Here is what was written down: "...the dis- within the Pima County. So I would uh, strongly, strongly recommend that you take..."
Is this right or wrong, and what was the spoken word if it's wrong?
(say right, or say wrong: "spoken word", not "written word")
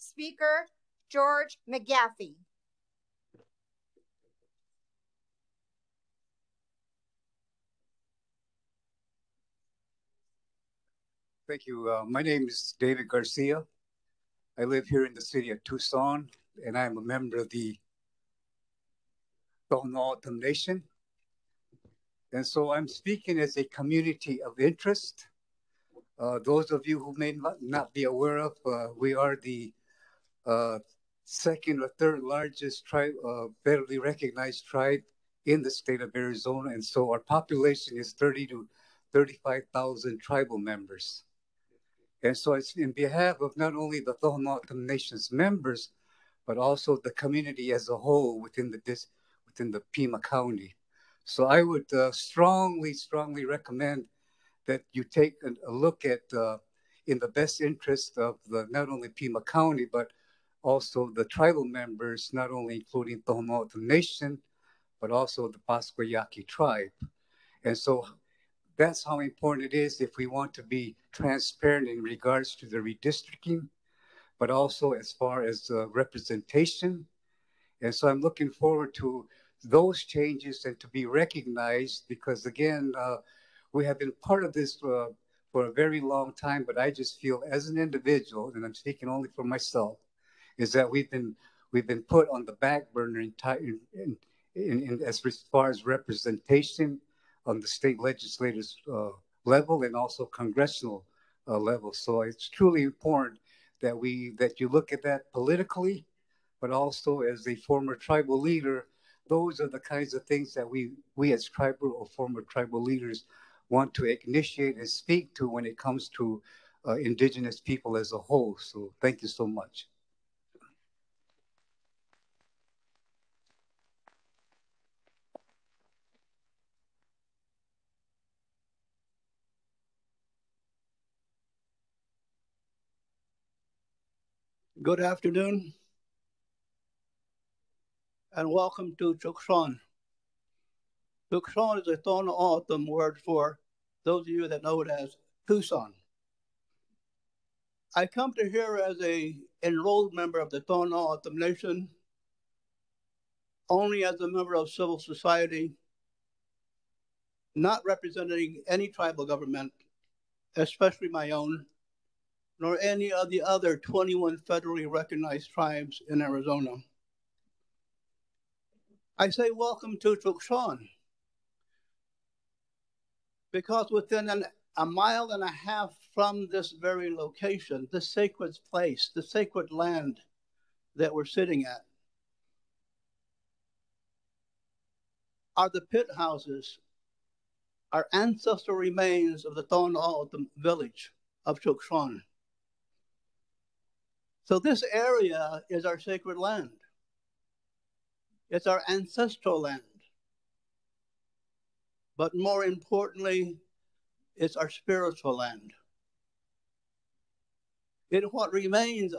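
right.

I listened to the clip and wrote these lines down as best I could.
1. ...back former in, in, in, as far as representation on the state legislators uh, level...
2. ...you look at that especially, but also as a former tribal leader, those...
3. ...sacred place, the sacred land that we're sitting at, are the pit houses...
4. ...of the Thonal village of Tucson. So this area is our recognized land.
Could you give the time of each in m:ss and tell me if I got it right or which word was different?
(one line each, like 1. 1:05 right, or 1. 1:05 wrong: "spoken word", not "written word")
1. 1:32 wrong: "burner", not "former"
2. 1:44 wrong: "politically", not "especially"
3. 2:58 right
4. 3:09 wrong: "sacred", not "recognized".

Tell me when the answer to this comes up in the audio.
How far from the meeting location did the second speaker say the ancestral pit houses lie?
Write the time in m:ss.
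2:54.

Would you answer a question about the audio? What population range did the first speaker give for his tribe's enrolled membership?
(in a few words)
30,000 to 35,000.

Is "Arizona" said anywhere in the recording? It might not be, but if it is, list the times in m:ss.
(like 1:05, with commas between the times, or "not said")
0:36, 2:46.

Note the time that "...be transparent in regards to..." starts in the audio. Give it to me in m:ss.
1:10.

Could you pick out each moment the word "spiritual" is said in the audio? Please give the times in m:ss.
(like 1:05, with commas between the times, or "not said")
3:24.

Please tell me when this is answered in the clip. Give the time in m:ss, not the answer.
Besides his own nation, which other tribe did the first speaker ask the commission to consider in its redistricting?
1:05.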